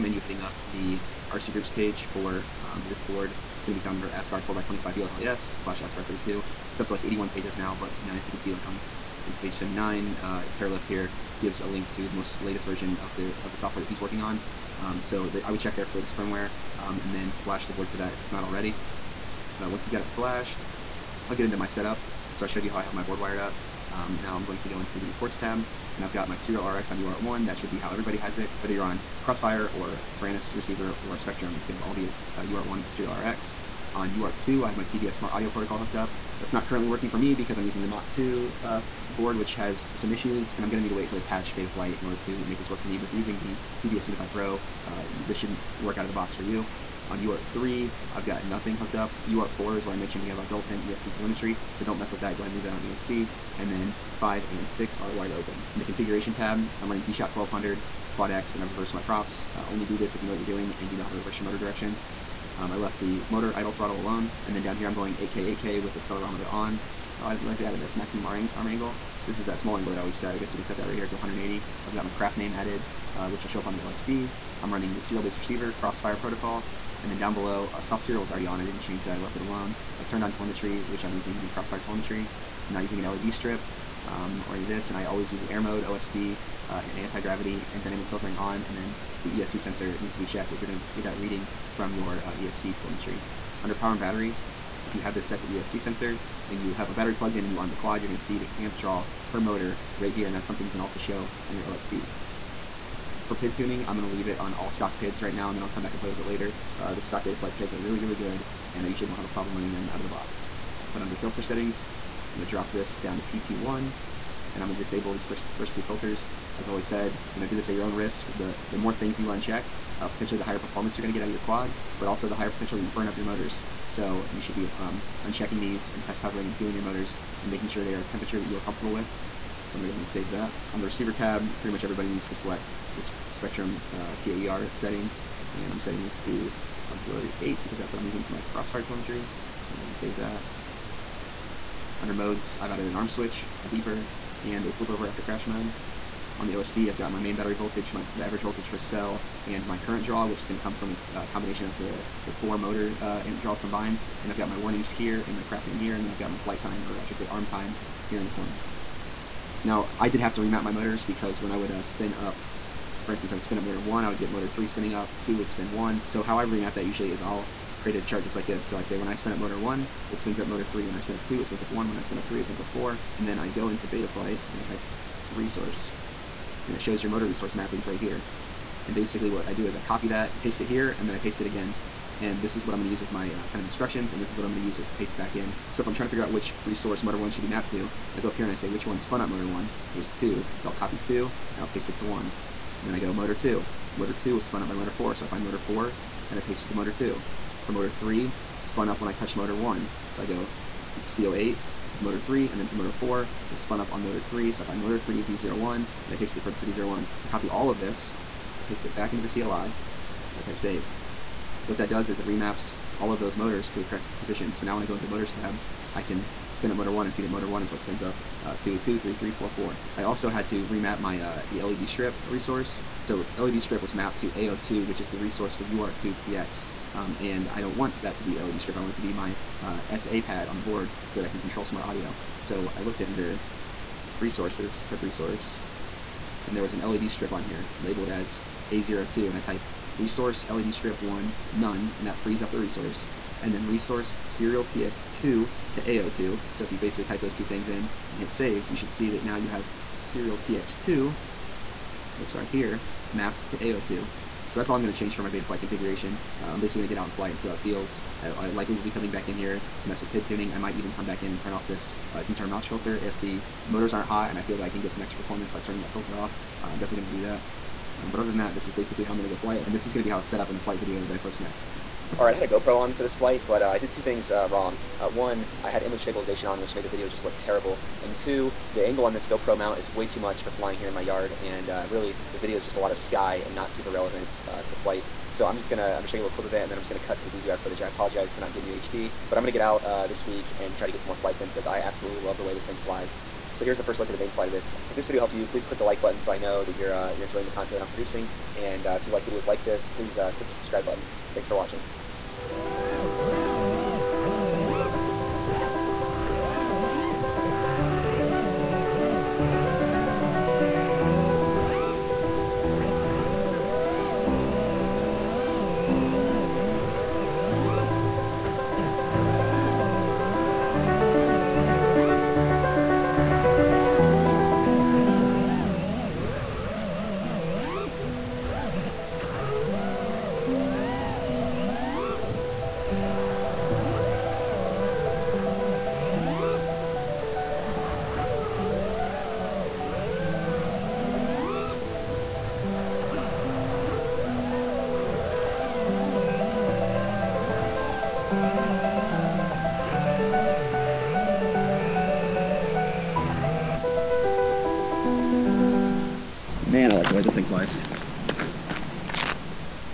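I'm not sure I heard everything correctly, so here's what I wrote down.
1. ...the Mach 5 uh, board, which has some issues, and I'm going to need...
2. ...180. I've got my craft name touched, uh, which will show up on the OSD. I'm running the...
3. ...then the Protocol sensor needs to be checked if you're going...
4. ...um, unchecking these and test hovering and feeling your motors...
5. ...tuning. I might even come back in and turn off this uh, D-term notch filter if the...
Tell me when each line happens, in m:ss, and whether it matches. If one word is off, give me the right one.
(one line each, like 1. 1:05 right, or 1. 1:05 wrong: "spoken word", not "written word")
1. 0:37 wrong: "2", not "5"
2. 1:11 wrong: "added", not "touched"
3. 1:28 wrong: "ESC", not "Protocol"
4. 2:04 right
5. 4:20 right.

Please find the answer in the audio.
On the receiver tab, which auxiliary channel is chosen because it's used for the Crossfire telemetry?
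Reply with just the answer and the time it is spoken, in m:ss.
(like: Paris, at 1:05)
auxiliary 8, at 2:16.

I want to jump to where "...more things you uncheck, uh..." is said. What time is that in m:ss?
1:58.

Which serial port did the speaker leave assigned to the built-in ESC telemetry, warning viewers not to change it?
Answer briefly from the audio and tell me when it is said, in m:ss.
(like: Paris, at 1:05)
UART4, at 0:49.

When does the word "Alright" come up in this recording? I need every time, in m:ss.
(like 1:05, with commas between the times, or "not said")
4:32.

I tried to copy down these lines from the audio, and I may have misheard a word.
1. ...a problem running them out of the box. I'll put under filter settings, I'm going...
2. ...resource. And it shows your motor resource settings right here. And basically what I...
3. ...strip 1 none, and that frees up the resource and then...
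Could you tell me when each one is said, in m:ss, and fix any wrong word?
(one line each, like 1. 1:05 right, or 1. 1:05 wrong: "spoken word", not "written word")
1. 1:49 right
2. 2:55 wrong: "mappings", not "settings"
3. 4:00 right.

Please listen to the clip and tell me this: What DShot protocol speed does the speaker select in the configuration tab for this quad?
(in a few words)
DShot 1200.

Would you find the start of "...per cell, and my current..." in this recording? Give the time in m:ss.
2:28.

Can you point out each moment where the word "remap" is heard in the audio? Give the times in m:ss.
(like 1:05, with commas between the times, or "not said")
2:40, 2:46, 3:32, 3:40.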